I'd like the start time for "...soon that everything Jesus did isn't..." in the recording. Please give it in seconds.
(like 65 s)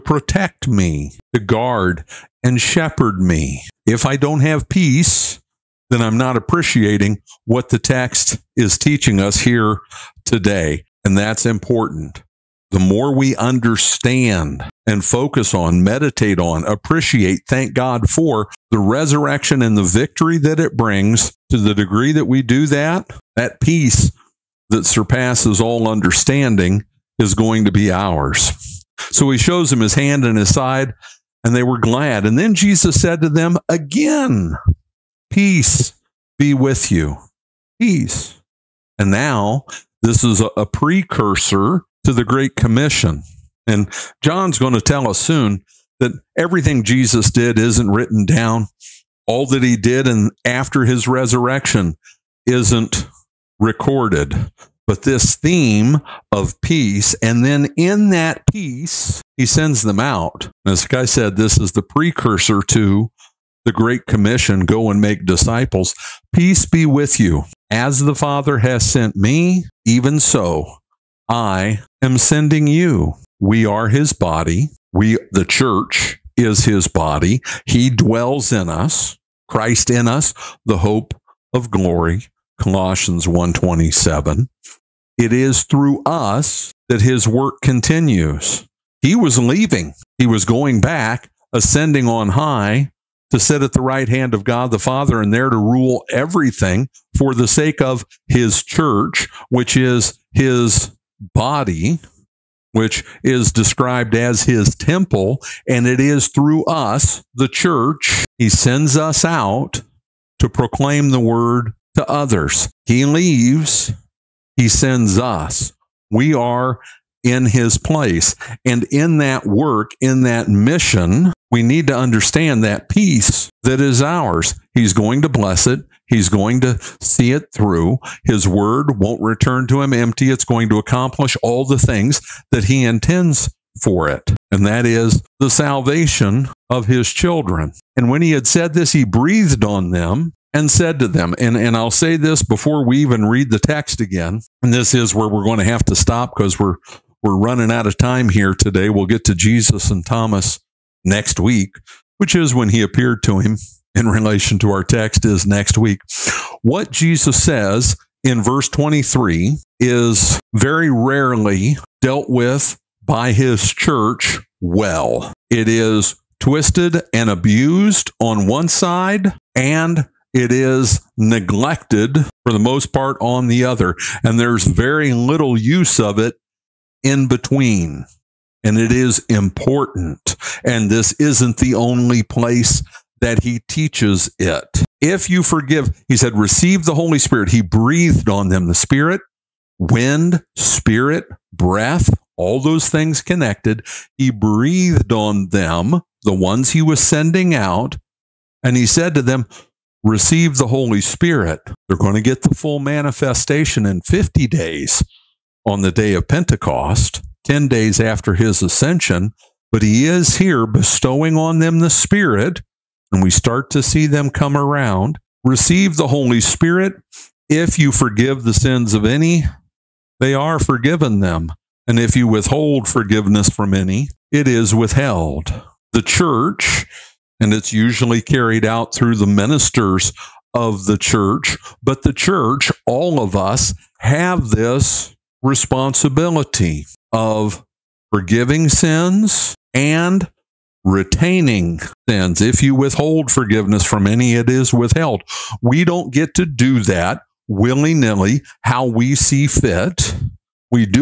45 s.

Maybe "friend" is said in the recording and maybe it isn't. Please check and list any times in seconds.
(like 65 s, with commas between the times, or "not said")
not said.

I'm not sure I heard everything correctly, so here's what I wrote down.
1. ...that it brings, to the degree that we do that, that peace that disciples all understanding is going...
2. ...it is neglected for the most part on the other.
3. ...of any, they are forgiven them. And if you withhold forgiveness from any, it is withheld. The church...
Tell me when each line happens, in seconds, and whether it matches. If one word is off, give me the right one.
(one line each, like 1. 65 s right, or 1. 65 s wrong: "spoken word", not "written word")
1. 20 s wrong: "surpasses", not "disciples"
2. 170 s right
3. 218 s right.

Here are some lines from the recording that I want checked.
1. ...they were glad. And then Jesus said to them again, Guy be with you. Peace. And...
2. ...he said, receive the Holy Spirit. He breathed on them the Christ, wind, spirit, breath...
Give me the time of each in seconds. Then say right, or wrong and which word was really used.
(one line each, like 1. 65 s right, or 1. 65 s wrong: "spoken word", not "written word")
1. 31 s wrong: "Peace", not "Guy"
2. 186 s wrong: "Spirit", not "Christ".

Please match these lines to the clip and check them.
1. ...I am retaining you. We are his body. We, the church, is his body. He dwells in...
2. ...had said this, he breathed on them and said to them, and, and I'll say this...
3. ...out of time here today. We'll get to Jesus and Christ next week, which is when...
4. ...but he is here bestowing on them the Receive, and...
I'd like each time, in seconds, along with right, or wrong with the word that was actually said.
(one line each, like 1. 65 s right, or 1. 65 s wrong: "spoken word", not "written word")
1. 71 s wrong: "sending", not "retaining"
2. 138 s right
3. 147 s wrong: "Thomas", not "Christ"
4. 209 s wrong: "Spirit", not "Receive".